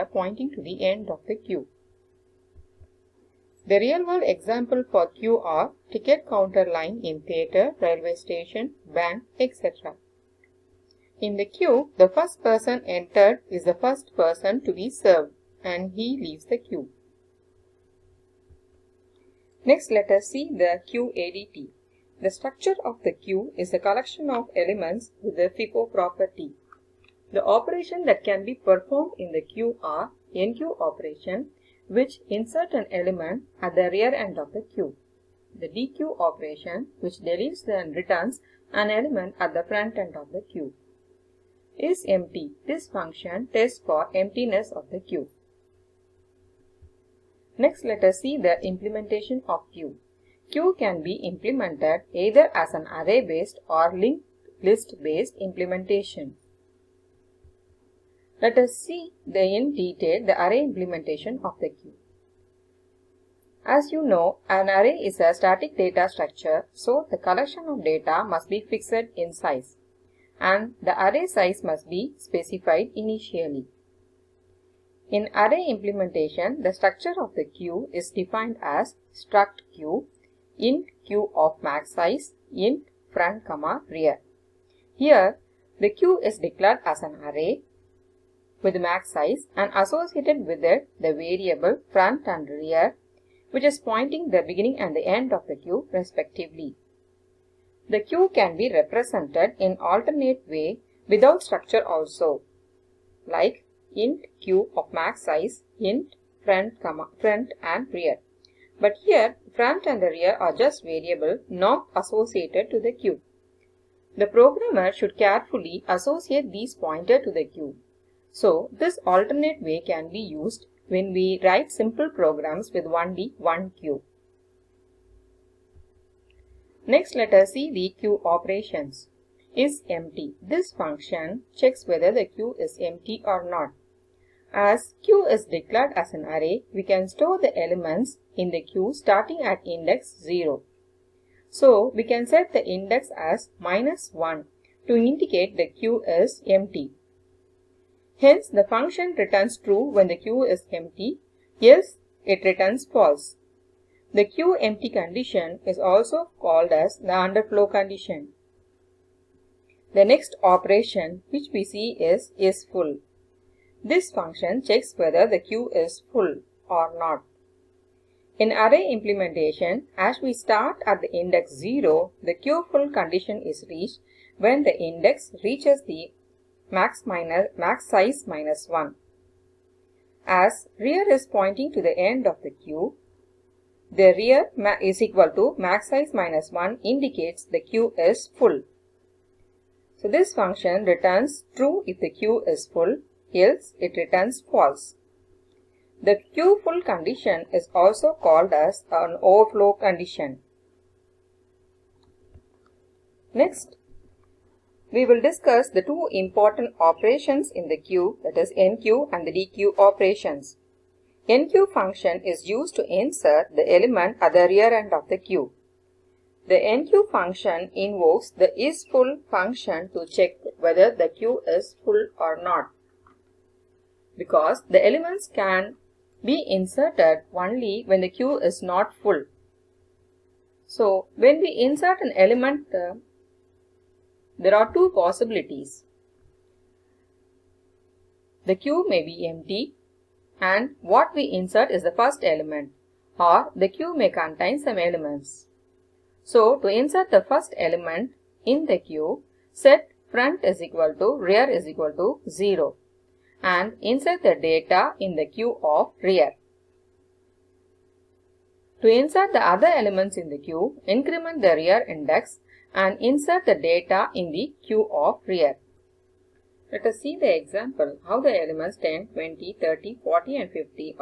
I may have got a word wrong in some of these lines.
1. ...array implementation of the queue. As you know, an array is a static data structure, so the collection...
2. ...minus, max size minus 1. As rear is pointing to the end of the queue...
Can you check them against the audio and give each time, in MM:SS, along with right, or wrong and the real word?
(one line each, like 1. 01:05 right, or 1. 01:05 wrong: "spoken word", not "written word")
1. 01:00 right
2. 02:57 right.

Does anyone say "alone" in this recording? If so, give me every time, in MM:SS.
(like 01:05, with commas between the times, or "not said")
not said.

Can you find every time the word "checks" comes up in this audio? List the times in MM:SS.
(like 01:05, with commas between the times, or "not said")
02:11, 02:44, 03:40.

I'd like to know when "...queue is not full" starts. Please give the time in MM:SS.
03:48.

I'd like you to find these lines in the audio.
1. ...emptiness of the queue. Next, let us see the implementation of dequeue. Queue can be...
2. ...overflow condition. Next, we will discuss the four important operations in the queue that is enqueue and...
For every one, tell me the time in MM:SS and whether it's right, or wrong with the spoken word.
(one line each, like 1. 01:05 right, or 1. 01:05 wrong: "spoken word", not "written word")
1. 00:44 wrong: "queue", not "dequeue"
2. 03:19 wrong: "two", not "four".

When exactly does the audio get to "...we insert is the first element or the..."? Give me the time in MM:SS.
04:01.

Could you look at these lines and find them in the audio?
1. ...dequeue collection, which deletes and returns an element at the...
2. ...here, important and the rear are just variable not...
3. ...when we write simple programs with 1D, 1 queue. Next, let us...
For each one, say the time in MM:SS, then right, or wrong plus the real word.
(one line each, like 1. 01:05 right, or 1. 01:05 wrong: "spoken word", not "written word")
1. 00:35 wrong: "operation", not "collection"
2. 01:49 wrong: "front", not "important"
3. 02:00 right.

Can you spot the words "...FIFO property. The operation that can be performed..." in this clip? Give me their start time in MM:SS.
00:25.